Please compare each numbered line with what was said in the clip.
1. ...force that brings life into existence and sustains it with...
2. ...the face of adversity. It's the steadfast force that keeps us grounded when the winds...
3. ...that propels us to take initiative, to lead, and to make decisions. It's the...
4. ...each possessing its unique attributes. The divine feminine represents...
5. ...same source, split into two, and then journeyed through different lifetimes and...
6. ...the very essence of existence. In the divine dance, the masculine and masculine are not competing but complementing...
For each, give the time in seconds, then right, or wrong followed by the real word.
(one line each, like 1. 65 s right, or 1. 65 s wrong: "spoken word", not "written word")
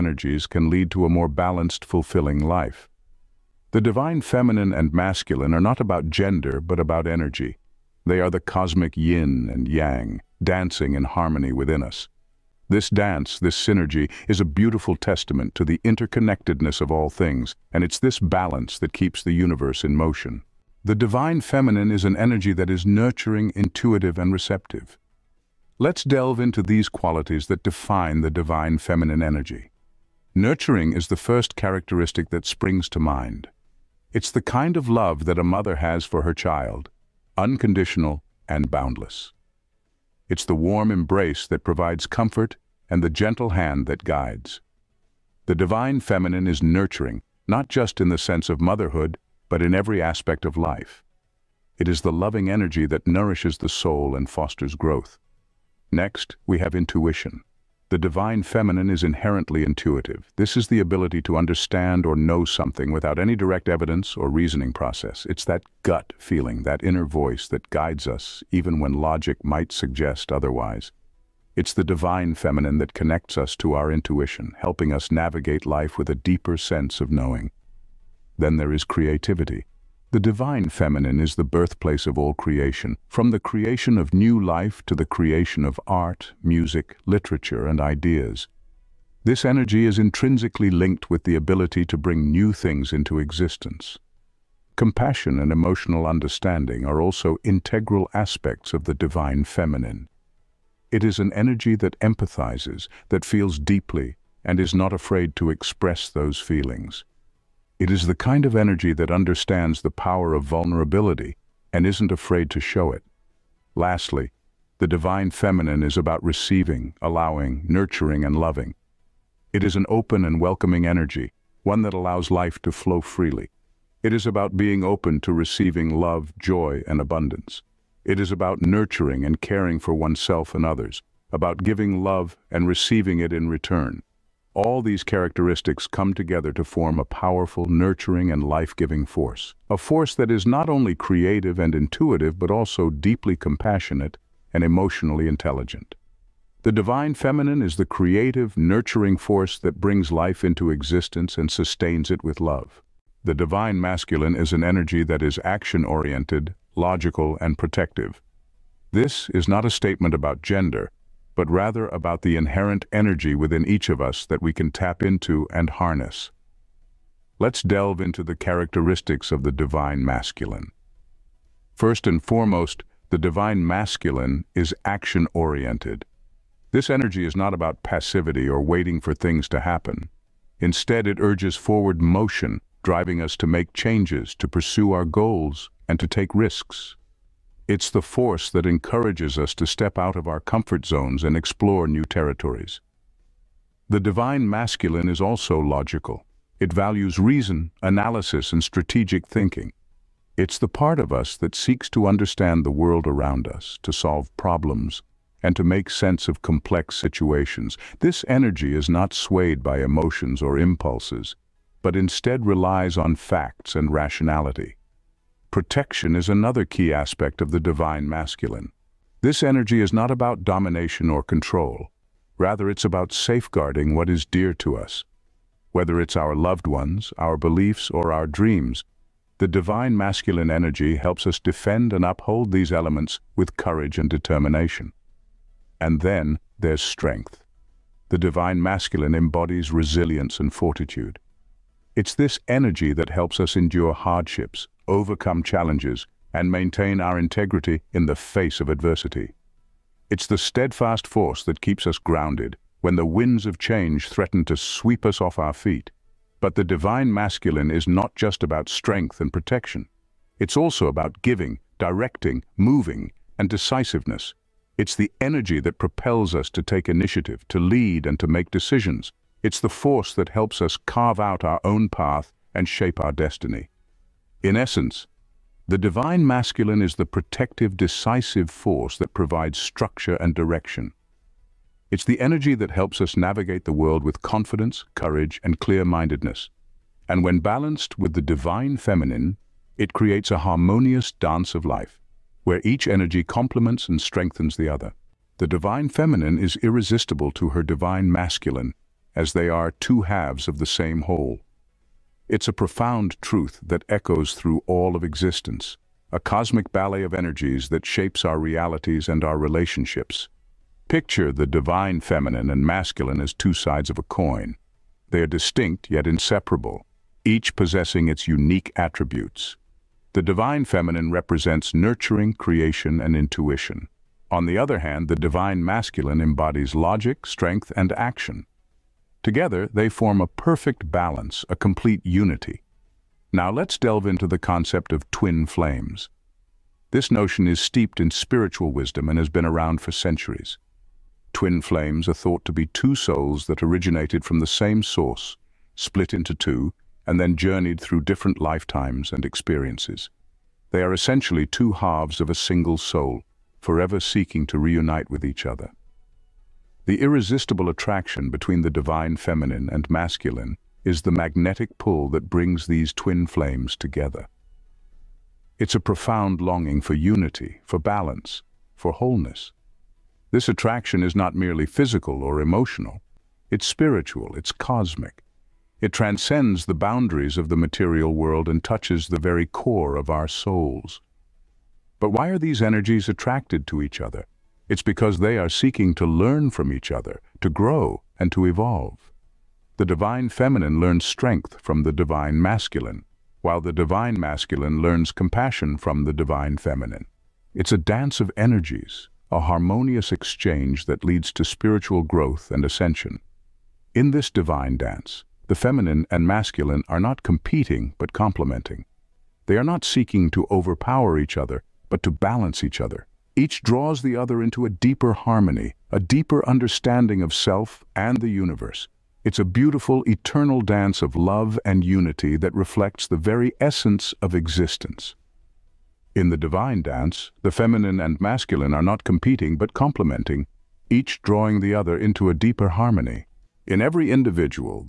1. 149 s right
2. 248 s right
3. 265 s right
4. 317 s right
5. 344 s right
6. 423 s wrong: "feminine", not "masculine".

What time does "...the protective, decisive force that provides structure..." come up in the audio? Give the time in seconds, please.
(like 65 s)
276 s.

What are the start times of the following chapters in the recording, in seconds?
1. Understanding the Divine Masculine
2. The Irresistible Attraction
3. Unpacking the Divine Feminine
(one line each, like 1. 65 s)
1. 152 s
2. 294 s
3. 20 s.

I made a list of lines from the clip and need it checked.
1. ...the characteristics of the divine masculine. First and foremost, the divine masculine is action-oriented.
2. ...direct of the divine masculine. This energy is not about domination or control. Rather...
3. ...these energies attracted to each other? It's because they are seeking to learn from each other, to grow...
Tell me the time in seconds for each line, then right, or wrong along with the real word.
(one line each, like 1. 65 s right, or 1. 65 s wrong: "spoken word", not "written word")
1. 168 s right
2. 216 s wrong: "aspect", not "direct"
3. 382 s right.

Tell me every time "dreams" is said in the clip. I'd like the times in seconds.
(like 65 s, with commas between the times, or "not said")
228 s.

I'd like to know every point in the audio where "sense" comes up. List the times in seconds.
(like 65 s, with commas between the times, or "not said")
48 s, 76 s, 205 s.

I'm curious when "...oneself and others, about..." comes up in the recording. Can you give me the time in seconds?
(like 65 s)
129 s.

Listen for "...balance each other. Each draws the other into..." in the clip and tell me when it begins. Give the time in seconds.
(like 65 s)
412 s.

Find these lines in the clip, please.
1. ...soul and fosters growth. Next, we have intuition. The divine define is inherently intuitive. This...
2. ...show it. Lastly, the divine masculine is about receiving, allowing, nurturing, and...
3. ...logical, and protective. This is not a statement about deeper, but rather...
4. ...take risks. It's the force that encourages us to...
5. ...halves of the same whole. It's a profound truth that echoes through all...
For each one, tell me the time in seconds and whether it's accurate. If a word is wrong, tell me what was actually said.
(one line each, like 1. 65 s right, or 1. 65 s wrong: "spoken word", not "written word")
1. 53 s wrong: "feminine", not "define"
2. 112 s wrong: "feminine", not "masculine"
3. 156 s wrong: "gender", not "deeper"
4. 186 s right
5. 300 s right.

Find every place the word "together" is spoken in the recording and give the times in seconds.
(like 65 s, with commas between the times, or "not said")
136 s, 329 s, 363 s.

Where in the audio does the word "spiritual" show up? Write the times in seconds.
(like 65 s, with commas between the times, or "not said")
338 s, 373 s, 401 s.